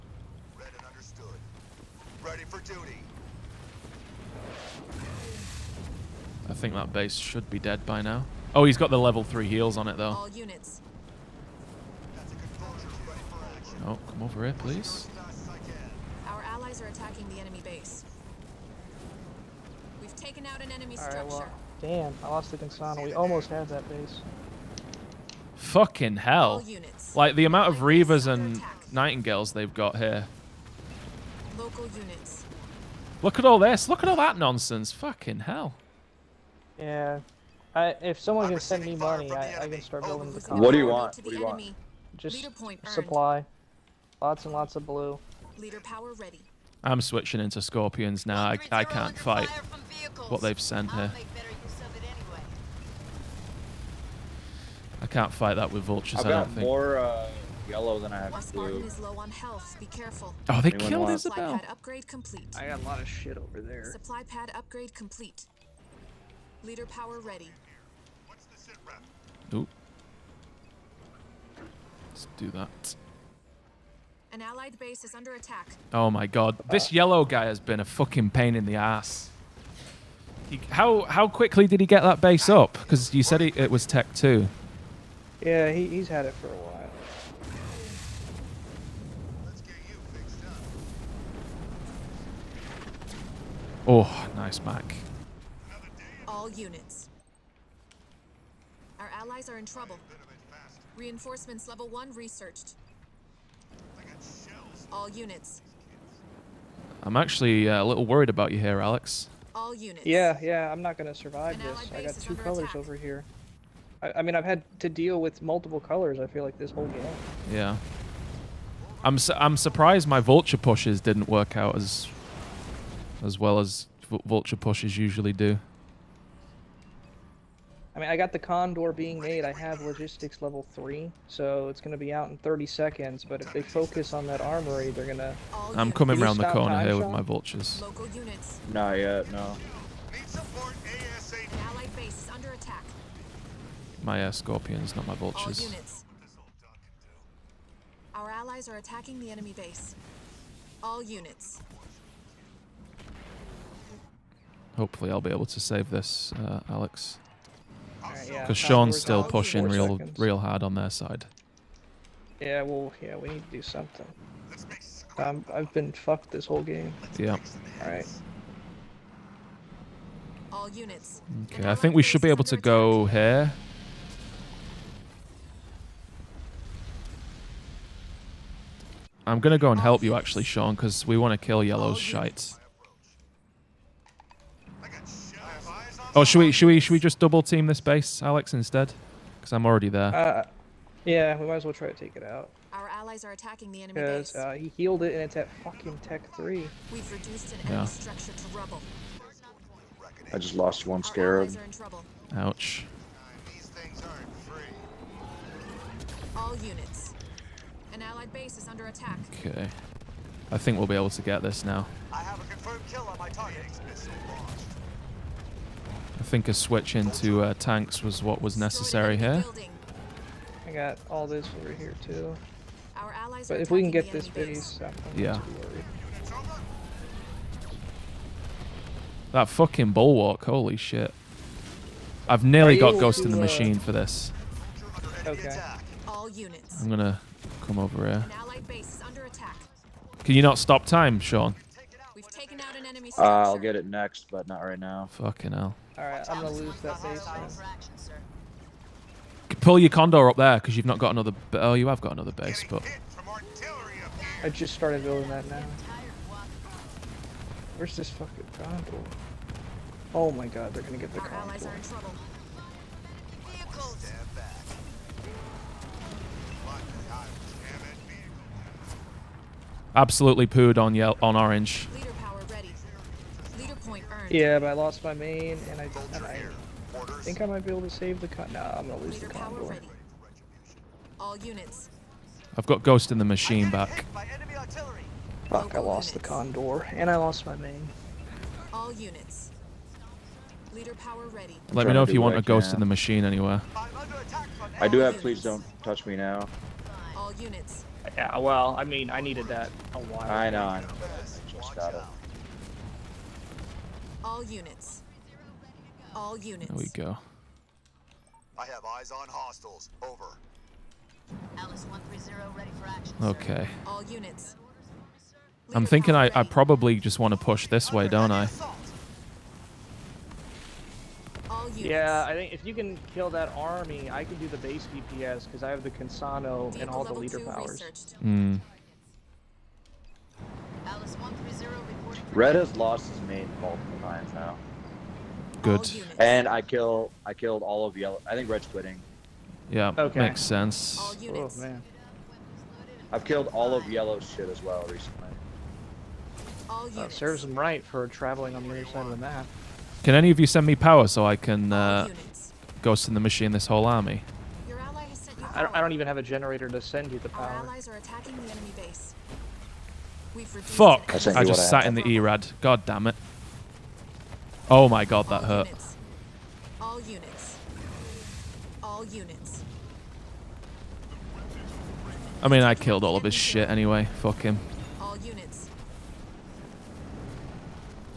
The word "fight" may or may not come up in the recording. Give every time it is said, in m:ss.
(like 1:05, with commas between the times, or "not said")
0:49, 0:55.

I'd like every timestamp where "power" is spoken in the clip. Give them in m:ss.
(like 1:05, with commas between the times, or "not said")
0:45, 1:06, 4:50, 5:27, 5:50, 5:57.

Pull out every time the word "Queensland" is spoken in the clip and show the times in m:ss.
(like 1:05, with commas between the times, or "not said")
not said.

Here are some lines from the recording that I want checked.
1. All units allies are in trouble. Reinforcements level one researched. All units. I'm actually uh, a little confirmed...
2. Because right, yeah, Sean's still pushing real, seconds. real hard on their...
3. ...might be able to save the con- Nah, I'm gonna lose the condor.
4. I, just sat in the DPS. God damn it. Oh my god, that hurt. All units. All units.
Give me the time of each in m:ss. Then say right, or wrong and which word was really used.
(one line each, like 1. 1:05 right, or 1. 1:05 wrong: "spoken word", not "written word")
1. 1:36 wrong: "worried", not "confirmed"
2. 2:38 right
3. 4:37 right
4. 6:01 wrong: "ERAD", not "DPS".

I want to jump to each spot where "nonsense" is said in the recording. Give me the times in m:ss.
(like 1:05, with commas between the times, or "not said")
0:34.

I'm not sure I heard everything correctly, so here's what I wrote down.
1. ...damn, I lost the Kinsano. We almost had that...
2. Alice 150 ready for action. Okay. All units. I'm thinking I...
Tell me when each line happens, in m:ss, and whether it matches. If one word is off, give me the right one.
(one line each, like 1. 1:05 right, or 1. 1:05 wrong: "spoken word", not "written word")
1. 0:21 right
2. 5:11 wrong: "130", not "150".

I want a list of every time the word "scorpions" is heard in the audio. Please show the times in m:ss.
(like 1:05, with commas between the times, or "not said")
0:47, 2:24.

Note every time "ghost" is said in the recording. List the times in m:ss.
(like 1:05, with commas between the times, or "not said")
3:52, 4:42, 4:52, 5:52.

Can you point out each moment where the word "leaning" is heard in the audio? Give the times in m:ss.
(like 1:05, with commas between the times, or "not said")
not said.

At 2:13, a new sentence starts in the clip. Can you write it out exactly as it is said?
But if they focus on that armory, they're going to...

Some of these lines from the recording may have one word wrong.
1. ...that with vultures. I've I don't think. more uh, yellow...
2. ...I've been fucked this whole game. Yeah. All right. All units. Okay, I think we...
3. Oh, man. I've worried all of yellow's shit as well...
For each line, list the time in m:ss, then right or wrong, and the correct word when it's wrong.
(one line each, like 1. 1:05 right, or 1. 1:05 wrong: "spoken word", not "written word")
1. 0:55 right
2. 2:45 right
3. 5:40 wrong: "killed", not "worried".